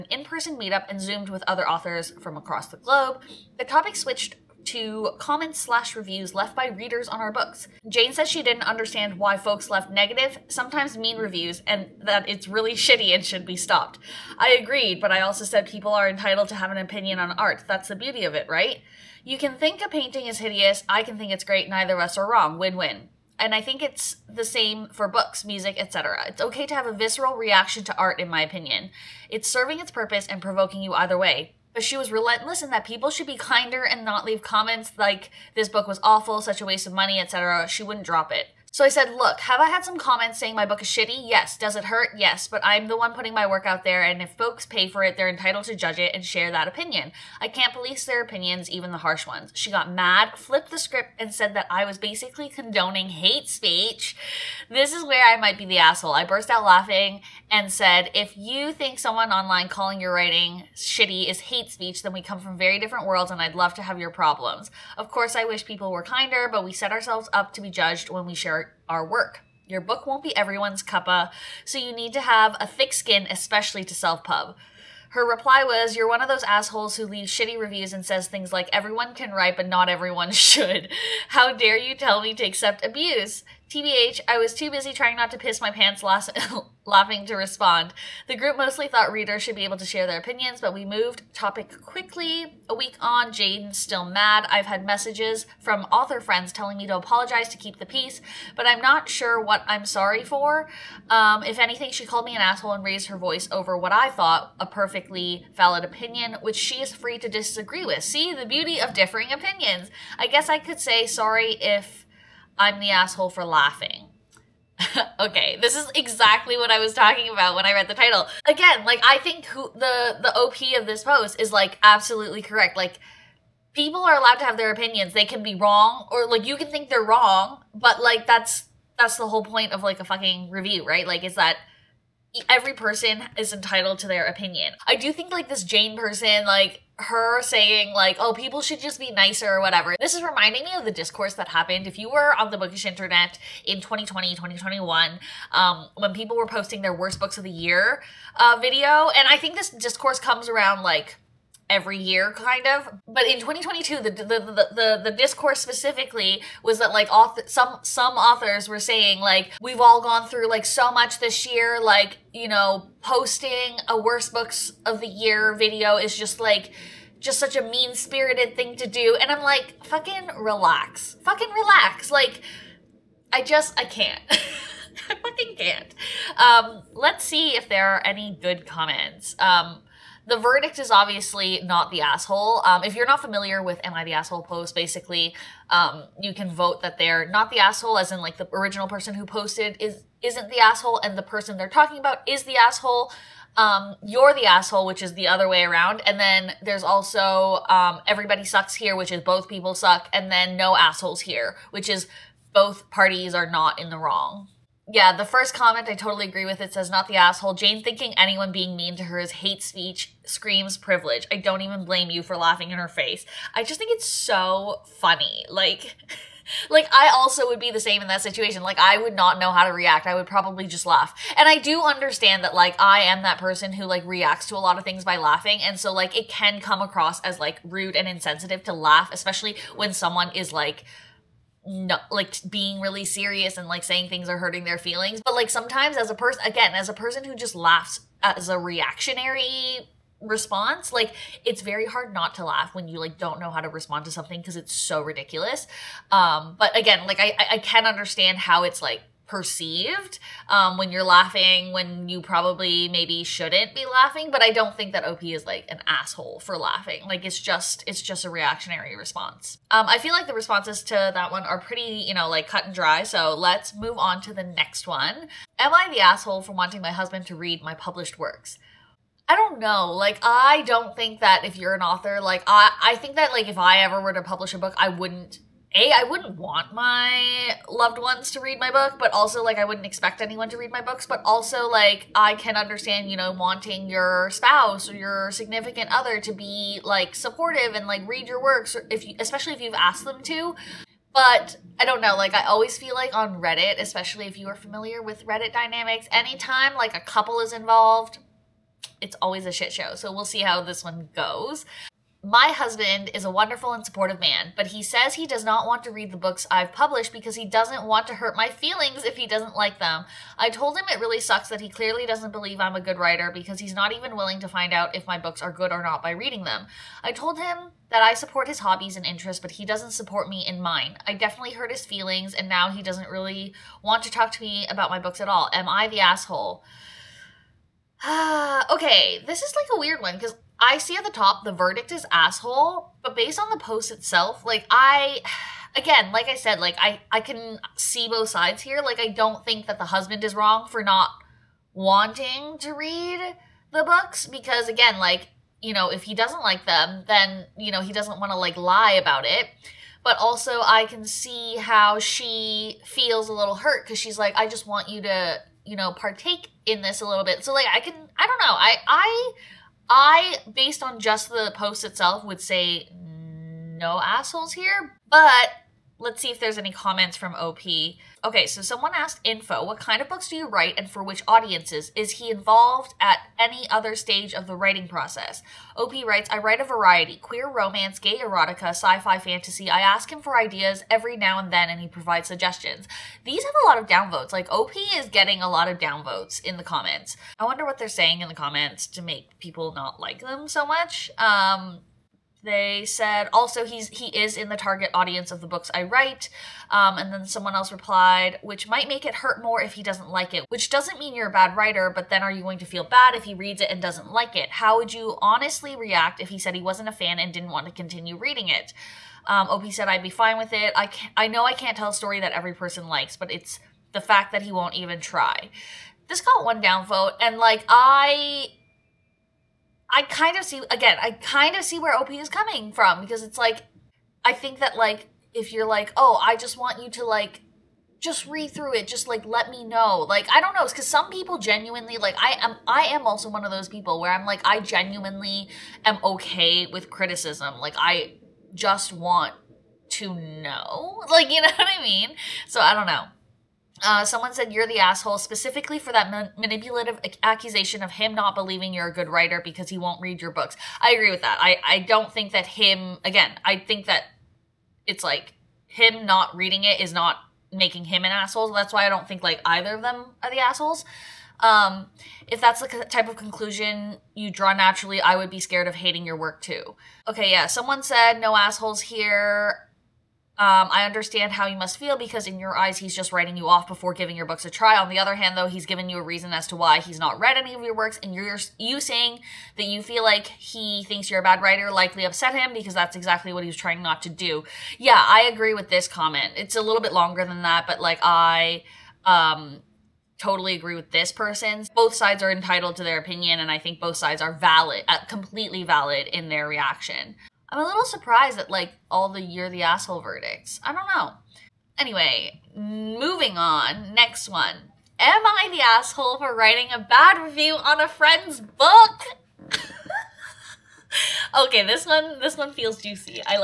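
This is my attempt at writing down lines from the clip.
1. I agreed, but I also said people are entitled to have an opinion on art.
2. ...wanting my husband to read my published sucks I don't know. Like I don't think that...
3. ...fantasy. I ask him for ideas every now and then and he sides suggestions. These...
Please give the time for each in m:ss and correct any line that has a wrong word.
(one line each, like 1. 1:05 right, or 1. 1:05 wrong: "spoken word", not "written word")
1. 0:14 right
2. 4:26 wrong: "works", not "sucks"
3. 6:19 wrong: "provides", not "sides".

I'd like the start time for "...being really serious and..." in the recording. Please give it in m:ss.
3:52.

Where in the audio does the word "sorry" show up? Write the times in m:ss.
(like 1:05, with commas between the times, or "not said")
1:39, 1:51.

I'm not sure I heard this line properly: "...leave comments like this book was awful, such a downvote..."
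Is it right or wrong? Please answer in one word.
wrong.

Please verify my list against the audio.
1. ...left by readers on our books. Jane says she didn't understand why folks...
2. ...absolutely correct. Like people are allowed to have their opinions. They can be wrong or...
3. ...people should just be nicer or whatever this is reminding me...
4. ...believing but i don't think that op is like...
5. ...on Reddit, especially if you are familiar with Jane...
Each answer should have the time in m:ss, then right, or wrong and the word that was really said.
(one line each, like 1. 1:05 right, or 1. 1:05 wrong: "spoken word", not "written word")
1. 0:06 right
2. 2:01 right
3. 2:18 right
4. 4:13 wrong: "laughing", not "believing"
5. 4:53 wrong: "Reddit", not "Jane".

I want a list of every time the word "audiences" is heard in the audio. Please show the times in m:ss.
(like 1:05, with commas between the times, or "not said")
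6:11, 6:34.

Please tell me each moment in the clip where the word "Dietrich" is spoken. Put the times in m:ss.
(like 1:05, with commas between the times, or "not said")
not said.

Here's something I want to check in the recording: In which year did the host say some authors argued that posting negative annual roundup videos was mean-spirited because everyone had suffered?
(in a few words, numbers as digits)
2022.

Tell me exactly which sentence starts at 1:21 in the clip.
How dare you tell me to accept abuse?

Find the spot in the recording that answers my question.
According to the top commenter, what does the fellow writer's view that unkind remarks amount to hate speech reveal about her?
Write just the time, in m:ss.
3:30.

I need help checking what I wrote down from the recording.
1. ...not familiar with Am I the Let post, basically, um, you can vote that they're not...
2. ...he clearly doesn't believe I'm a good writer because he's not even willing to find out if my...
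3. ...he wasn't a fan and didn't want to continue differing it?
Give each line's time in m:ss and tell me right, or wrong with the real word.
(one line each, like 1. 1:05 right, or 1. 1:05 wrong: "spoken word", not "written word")
1. 3:03 wrong: "Asshole", not "Let"
2. 5:11 right
3. 6:46 wrong: "reading", not "differing".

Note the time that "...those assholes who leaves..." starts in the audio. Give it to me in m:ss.
1:16.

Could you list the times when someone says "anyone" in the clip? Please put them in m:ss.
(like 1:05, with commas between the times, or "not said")
3:28, 4:40.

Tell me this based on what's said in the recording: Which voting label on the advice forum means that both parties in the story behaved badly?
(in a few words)
everybody sucks here.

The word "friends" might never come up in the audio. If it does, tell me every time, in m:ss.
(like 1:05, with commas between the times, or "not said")
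1:36, 8:27.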